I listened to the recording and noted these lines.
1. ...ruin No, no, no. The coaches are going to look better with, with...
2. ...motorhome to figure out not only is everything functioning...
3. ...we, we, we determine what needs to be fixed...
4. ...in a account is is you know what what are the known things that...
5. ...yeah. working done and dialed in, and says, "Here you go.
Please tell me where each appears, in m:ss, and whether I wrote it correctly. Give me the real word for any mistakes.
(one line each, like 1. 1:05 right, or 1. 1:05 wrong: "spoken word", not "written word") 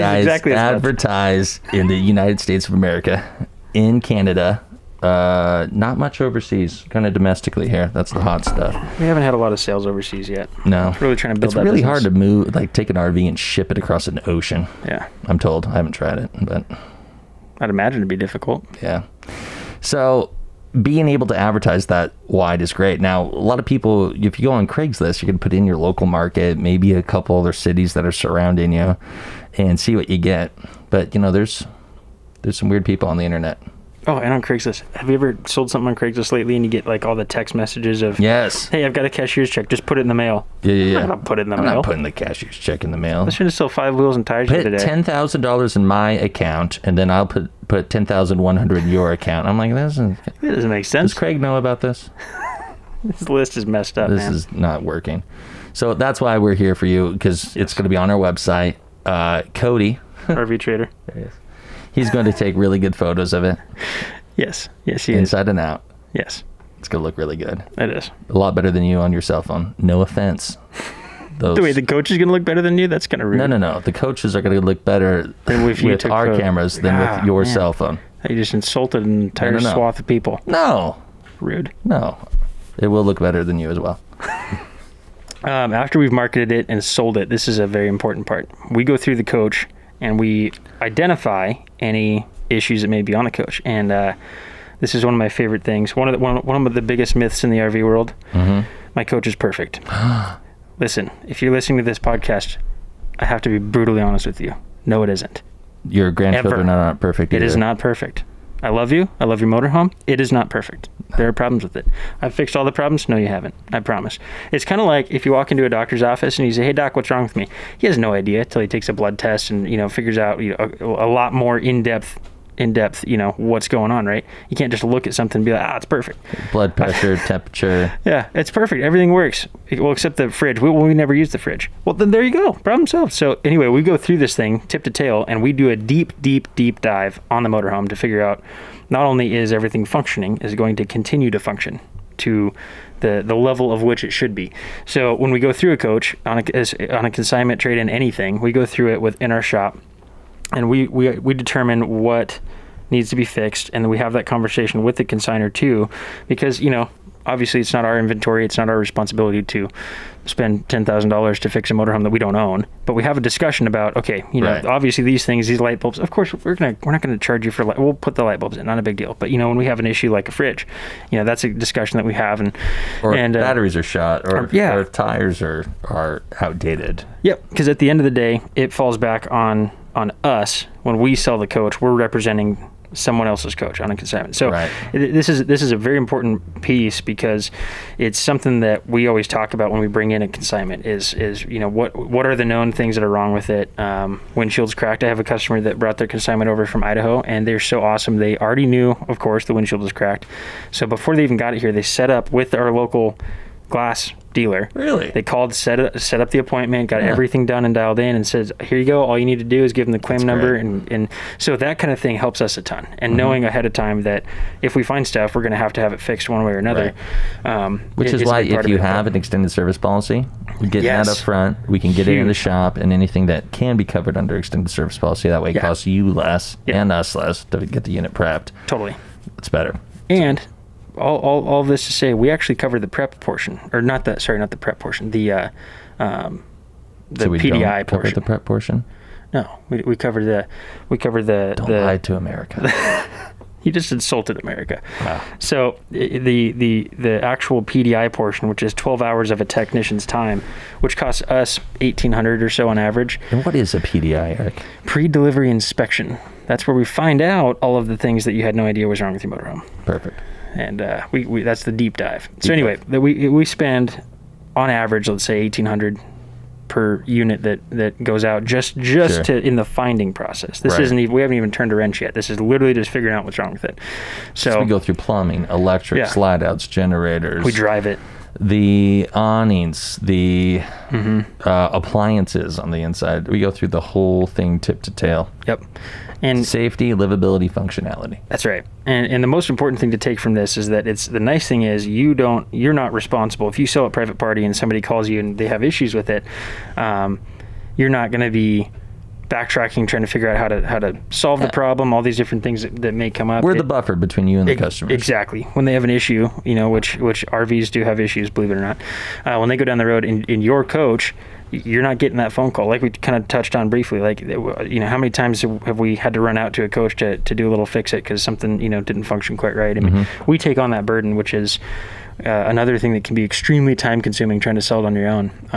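1. 1:13 right
2. 2:17 right
3. 2:30 right
4. 3:10 wrong: "consignment", not "account"
5. 3:27 wrong: "everything", not "working".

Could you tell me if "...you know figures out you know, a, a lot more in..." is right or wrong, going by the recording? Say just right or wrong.
right.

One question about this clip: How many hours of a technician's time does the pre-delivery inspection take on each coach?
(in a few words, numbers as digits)
12 hours.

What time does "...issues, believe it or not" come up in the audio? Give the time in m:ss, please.
5:07.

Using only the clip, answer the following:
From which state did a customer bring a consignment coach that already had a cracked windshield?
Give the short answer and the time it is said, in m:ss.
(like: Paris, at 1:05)
Idaho, at 3:16.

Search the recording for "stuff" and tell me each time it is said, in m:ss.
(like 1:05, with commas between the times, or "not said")
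0:08, 3:35.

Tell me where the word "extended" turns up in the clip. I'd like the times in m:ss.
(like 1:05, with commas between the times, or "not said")
3:39, 3:44.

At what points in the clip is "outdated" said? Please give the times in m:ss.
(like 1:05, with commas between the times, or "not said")
2:56.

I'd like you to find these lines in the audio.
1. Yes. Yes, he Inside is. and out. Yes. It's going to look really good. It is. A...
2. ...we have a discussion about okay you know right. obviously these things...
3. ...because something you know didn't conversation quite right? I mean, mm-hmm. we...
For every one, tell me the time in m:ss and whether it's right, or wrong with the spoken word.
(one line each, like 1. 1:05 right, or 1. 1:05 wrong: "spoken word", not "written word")
1. 1:04 right
2. 2:42 right
3. 5:17 wrong: "function", not "conversation".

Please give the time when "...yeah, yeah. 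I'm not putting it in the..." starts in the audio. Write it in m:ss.
0:40.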